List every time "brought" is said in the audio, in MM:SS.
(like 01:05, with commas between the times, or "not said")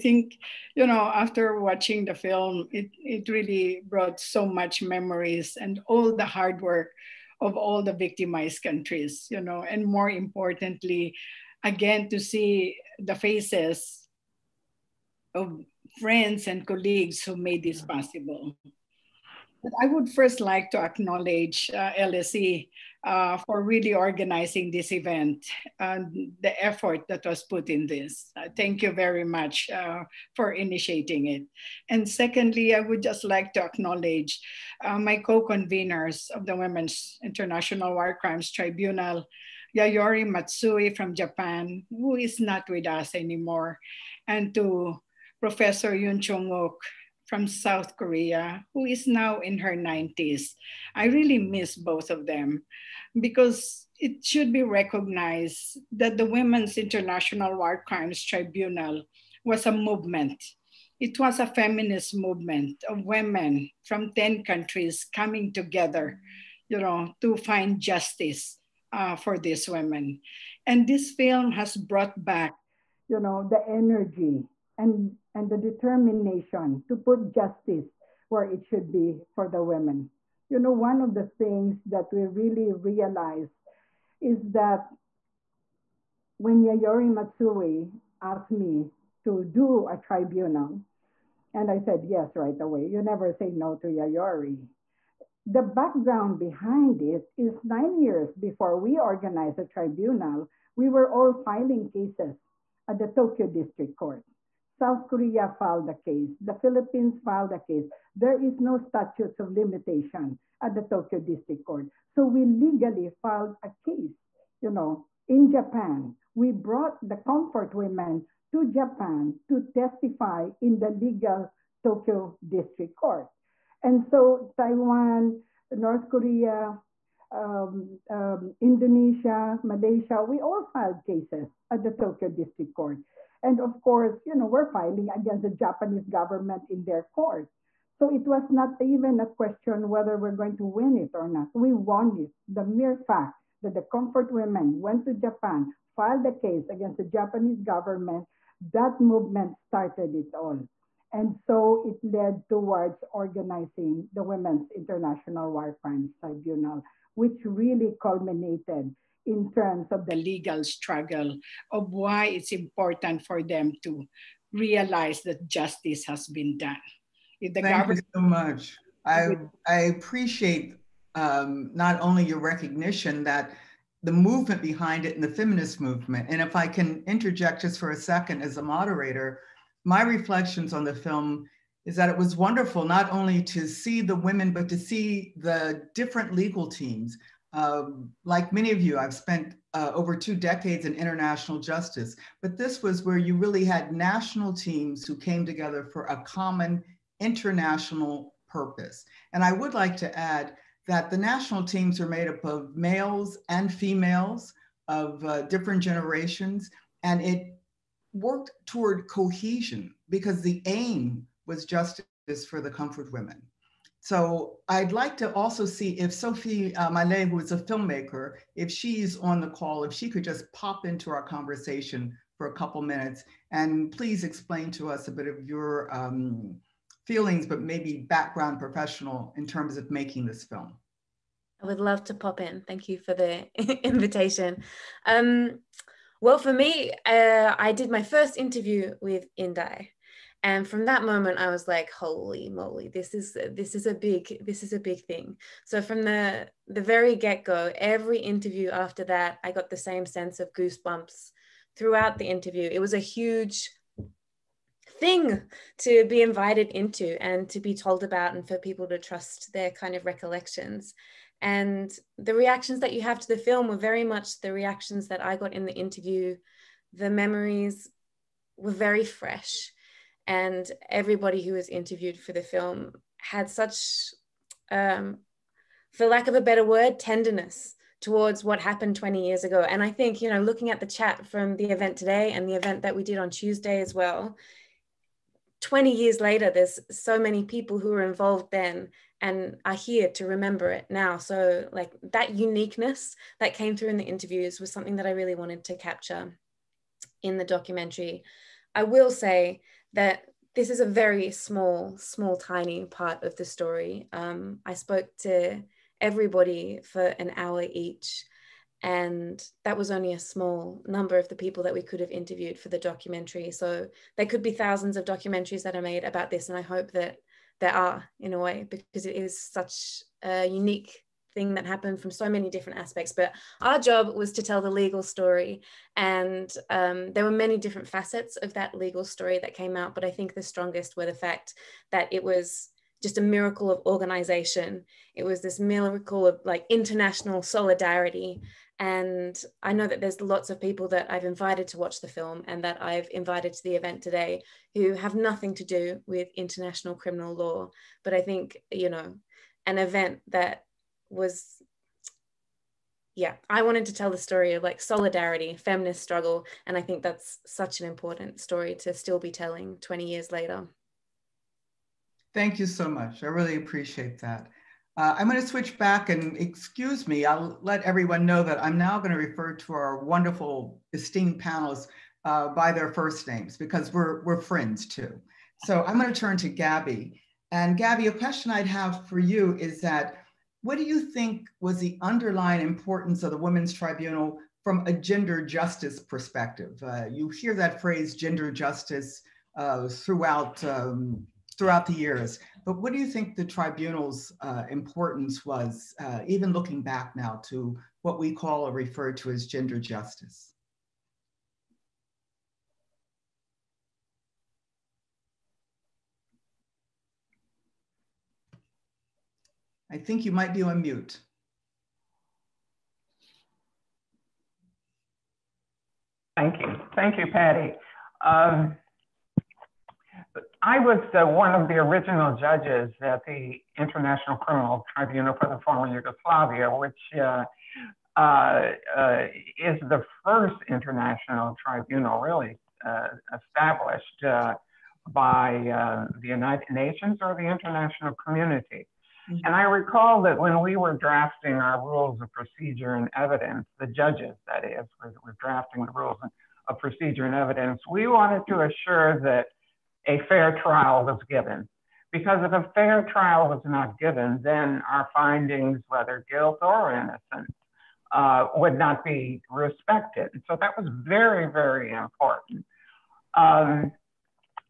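00:03, 01:11, 01:56.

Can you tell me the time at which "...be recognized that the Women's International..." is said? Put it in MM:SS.
00:54.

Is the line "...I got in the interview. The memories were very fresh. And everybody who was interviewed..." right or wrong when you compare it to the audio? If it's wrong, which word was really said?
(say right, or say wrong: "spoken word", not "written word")
right.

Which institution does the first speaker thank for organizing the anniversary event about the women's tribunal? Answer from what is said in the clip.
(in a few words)
LSE.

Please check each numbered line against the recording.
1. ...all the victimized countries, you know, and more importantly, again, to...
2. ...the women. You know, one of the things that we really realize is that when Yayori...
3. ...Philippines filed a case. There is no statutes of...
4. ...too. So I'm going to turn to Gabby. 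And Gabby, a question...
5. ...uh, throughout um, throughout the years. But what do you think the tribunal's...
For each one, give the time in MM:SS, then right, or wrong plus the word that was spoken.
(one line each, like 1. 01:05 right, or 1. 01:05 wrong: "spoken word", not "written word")
1. 00:07 right
2. 01:19 right
3. 01:46 right
4. 06:14 right
5. 06:29 right.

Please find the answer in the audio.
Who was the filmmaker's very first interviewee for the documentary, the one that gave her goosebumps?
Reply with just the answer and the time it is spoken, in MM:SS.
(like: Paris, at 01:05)
Indai, at 03:59.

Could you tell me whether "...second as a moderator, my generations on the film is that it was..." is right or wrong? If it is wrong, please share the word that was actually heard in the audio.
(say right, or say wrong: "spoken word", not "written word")
wrong: "reflections", not "generations".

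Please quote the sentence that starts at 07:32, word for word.
Because if a fair trial was not given, then our findings, whether guilt or innocence, uh, would not be respected.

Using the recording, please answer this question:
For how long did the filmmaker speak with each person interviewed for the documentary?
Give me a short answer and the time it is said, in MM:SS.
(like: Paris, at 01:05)
an hour, at 05:07.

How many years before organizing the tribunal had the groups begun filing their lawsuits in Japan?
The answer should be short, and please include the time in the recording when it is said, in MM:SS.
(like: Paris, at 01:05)
9, at 01:37.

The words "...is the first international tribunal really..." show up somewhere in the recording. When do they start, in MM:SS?
07:09.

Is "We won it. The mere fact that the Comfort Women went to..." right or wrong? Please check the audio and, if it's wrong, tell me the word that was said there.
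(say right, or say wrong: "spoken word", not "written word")
right.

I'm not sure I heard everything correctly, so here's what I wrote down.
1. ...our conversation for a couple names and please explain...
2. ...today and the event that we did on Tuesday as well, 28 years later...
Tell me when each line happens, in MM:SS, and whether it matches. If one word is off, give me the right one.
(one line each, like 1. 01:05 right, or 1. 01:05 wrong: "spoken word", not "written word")
1. 03:41 wrong: "minutes", not "names"
2. 04:41 wrong: "20", not "28".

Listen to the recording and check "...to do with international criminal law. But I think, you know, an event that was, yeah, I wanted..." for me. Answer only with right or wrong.
right.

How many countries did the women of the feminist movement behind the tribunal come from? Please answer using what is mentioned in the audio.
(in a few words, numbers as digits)
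10.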